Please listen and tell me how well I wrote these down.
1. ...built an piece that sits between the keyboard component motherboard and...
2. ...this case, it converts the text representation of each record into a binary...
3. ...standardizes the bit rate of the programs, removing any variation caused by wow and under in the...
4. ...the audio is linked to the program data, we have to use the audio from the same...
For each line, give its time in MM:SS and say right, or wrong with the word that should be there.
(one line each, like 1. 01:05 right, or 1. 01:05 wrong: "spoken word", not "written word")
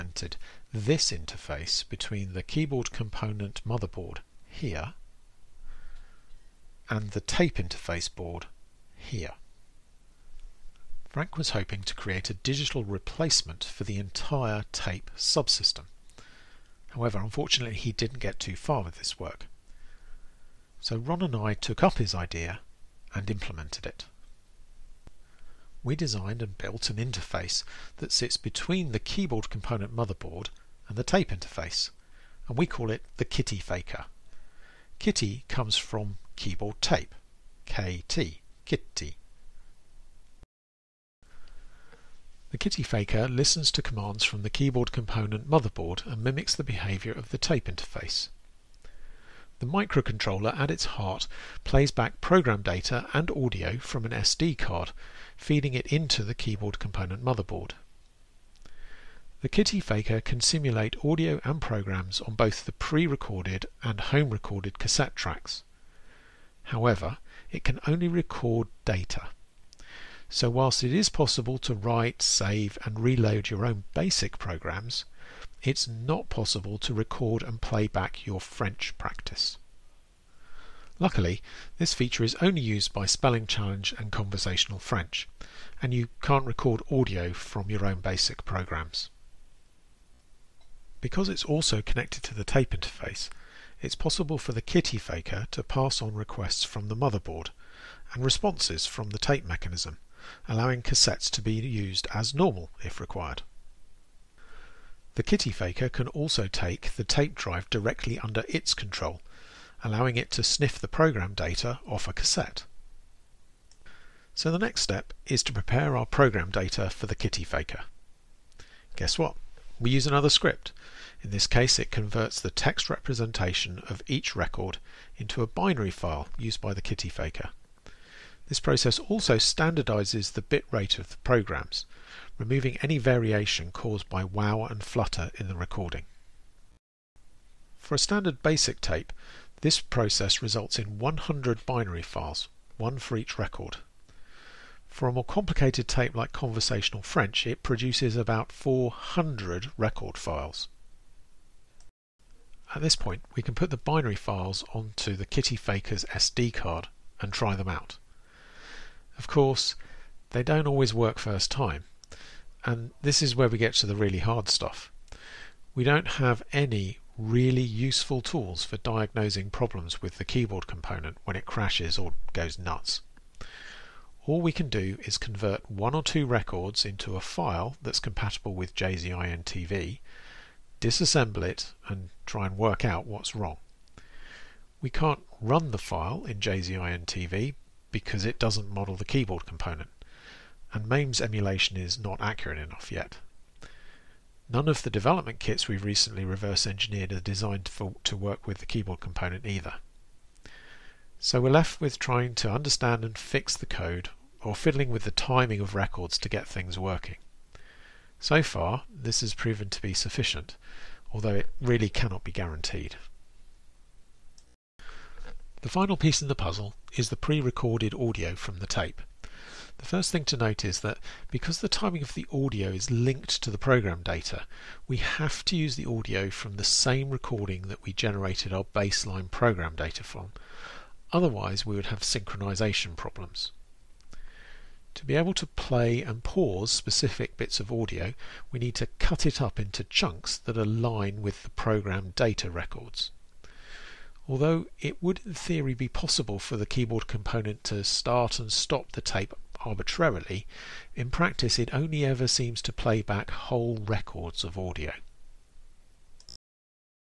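1. 00:26 wrong: "interface", not "piece"
2. 02:01 right
3. 02:09 wrong: "flutter", not "under"
4. 03:42 right.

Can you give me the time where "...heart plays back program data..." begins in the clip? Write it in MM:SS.
00:50.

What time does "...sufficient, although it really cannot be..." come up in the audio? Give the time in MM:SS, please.
03:29.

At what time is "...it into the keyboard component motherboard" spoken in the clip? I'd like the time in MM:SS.
00:55.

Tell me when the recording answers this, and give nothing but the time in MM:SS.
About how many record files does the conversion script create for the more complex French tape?
02:28.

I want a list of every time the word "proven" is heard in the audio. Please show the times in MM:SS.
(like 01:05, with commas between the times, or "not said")
03:29.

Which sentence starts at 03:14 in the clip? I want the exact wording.
None of the development kits we've recently reverse engineered are designed for, to work with the keyboard component either.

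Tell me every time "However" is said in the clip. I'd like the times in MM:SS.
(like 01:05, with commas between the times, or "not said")
00:16, 01:06.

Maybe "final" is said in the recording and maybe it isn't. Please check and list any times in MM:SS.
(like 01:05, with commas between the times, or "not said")
03:35.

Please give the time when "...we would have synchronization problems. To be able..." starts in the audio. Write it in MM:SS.
03:51.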